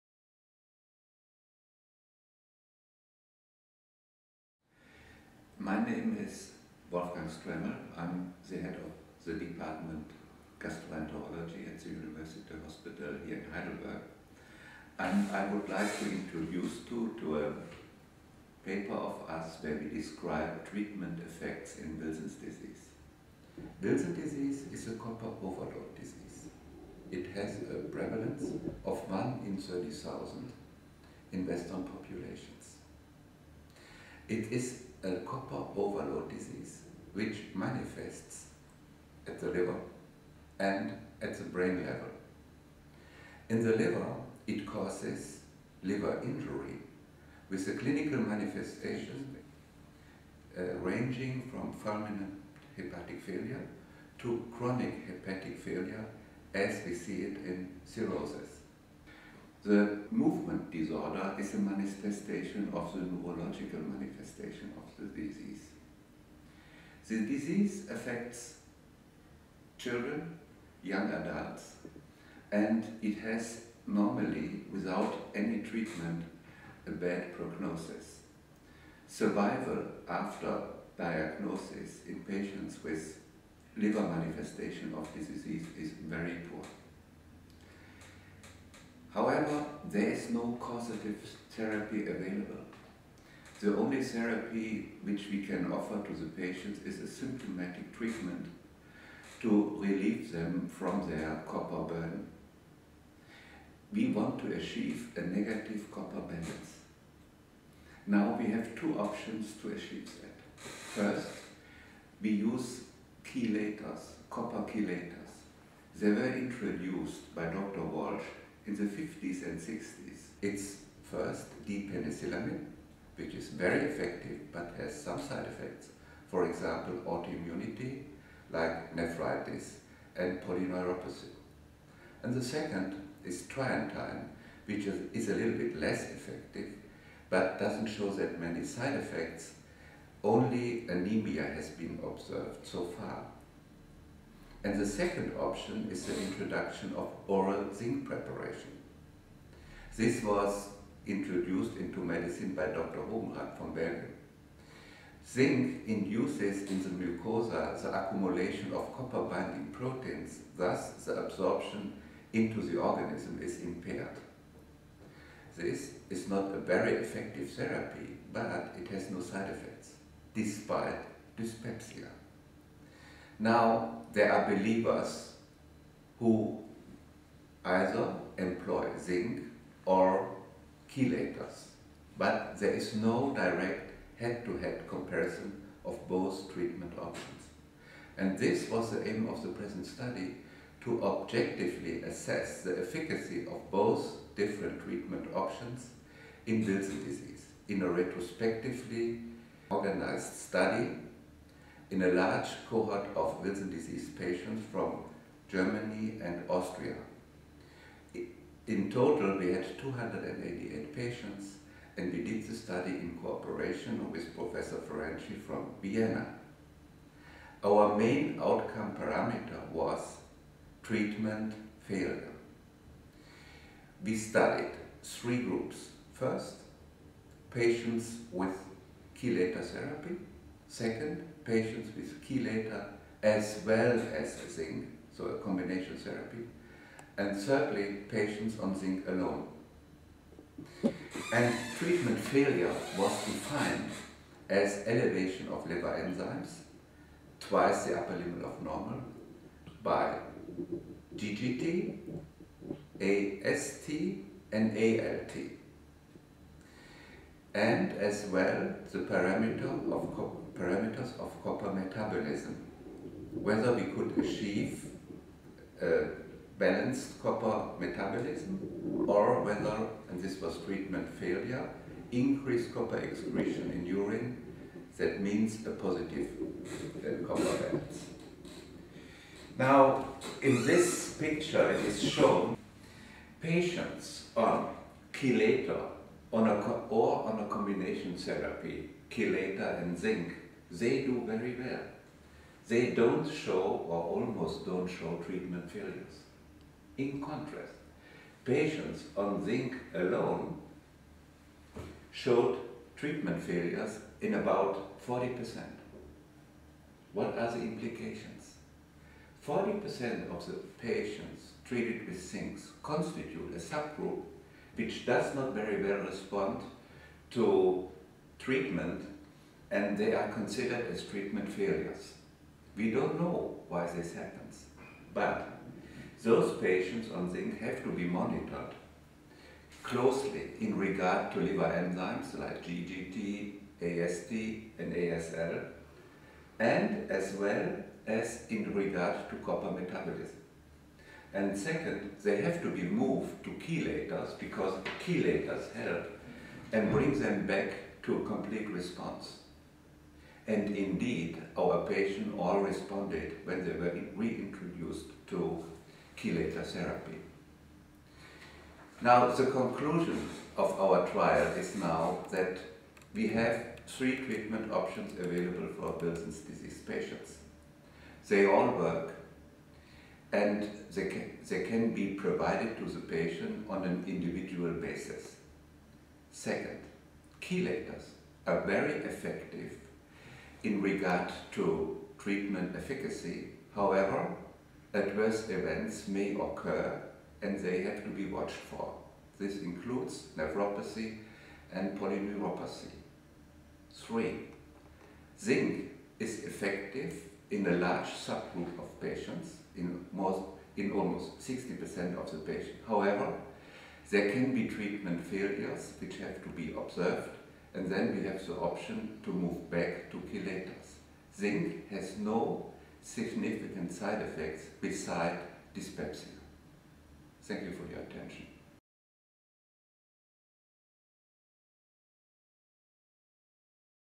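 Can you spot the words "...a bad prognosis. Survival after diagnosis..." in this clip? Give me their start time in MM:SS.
01:16.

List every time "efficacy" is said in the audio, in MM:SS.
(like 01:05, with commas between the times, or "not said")
03:12, 06:22.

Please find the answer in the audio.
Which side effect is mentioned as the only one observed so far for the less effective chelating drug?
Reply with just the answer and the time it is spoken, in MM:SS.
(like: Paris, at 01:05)
Anemia, at 02:20.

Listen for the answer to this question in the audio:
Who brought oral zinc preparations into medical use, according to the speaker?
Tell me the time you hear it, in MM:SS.
02:32.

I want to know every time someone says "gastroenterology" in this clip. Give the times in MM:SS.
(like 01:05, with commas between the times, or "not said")
00:10.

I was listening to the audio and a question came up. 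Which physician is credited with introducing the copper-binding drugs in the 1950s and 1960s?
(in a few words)
Dr. Walshe.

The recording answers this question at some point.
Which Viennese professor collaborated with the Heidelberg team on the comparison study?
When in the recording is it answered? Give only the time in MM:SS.
03:34.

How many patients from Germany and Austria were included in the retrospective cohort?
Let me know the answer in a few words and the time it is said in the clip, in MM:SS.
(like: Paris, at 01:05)
288, at 03:29.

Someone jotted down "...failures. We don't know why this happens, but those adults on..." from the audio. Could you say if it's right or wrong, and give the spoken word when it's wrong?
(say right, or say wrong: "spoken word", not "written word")
wrong: "patients", not "adults".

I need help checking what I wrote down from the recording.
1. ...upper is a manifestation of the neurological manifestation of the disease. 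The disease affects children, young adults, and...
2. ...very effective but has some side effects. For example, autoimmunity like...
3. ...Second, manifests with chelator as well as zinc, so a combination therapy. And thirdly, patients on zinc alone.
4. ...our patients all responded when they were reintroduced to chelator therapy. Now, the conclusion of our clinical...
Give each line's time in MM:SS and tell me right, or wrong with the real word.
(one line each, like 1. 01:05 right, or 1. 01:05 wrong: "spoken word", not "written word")
1. 01:00 wrong: "disorder", not "upper"
2. 02:03 right
3. 03:50 wrong: "patients", not "manifests"
4. 05:51 wrong: "trial", not "clinical".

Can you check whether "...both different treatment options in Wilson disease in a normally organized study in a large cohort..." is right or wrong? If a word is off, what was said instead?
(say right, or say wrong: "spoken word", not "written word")
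wrong: "retrospectively", not "normally".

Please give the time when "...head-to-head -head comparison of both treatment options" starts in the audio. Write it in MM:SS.
03:04.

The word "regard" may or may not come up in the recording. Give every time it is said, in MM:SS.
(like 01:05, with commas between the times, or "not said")
05:30, 05:38, 06:20.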